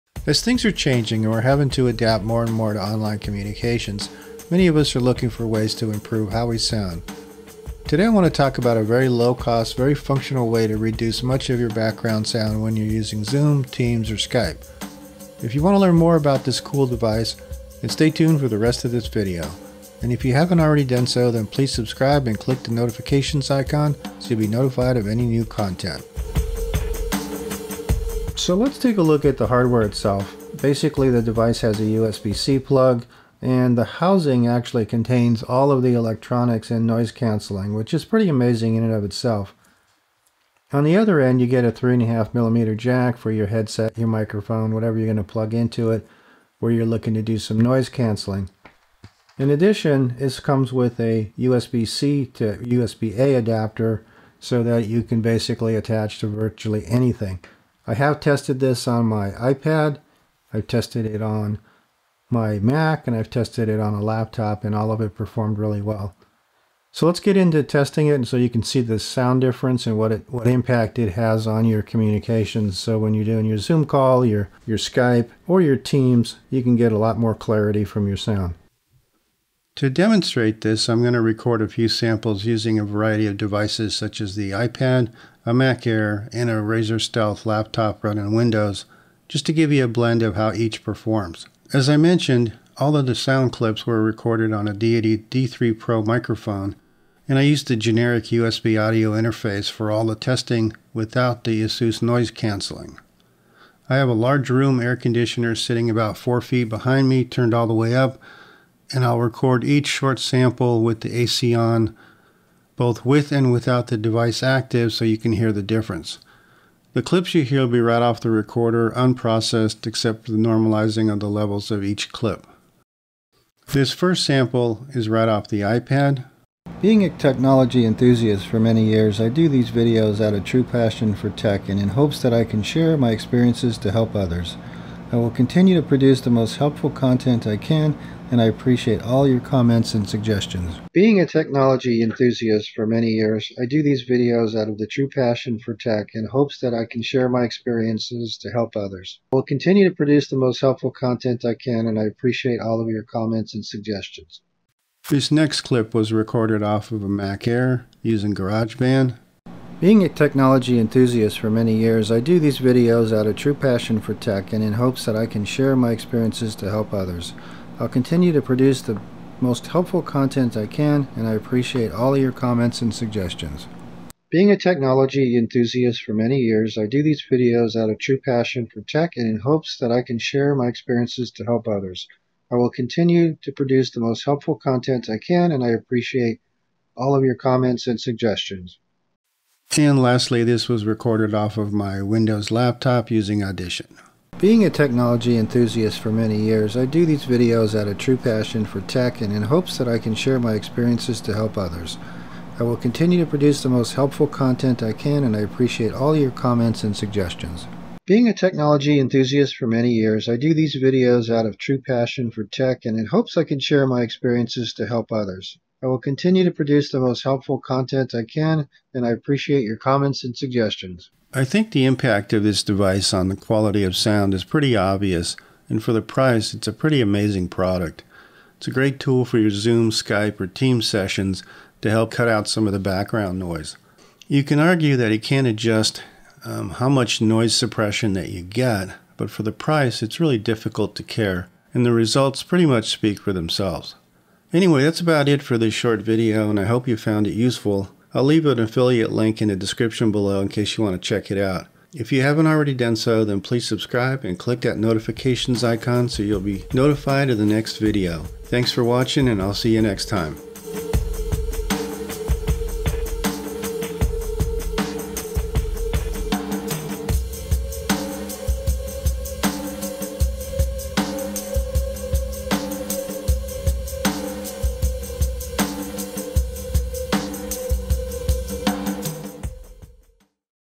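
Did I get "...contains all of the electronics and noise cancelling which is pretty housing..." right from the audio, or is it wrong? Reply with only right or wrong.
wrong.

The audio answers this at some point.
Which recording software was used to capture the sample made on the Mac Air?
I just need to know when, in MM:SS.
02:38.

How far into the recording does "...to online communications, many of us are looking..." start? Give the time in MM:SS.
00:02.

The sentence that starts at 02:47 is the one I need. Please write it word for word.
I'll continue to produce the most helpful content I can, and I appreciate all your comments and suggestions.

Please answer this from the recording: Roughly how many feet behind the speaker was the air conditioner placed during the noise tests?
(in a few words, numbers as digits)
4 feet.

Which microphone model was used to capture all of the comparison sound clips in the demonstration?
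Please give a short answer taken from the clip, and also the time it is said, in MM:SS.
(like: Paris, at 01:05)
Deity D3 Pro, at 01:34.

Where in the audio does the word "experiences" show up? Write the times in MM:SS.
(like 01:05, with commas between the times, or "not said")
02:13, 02:27, 02:45, 03:00, 03:20, 03:34.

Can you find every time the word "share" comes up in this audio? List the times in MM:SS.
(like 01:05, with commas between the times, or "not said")
02:12, 02:27, 02:45, 03:00, 03:20, 03:33.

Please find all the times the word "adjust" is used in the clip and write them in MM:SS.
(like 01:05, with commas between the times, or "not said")
03:55.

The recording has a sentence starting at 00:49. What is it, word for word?
In addition, this comes with a USB-C to USB-A adapter so that you can basically attach to virtually anything.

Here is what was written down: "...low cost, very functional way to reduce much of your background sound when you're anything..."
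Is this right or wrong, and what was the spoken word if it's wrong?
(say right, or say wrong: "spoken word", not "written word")
wrong: "using", not "anything".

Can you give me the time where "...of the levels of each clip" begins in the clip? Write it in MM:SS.
02:01.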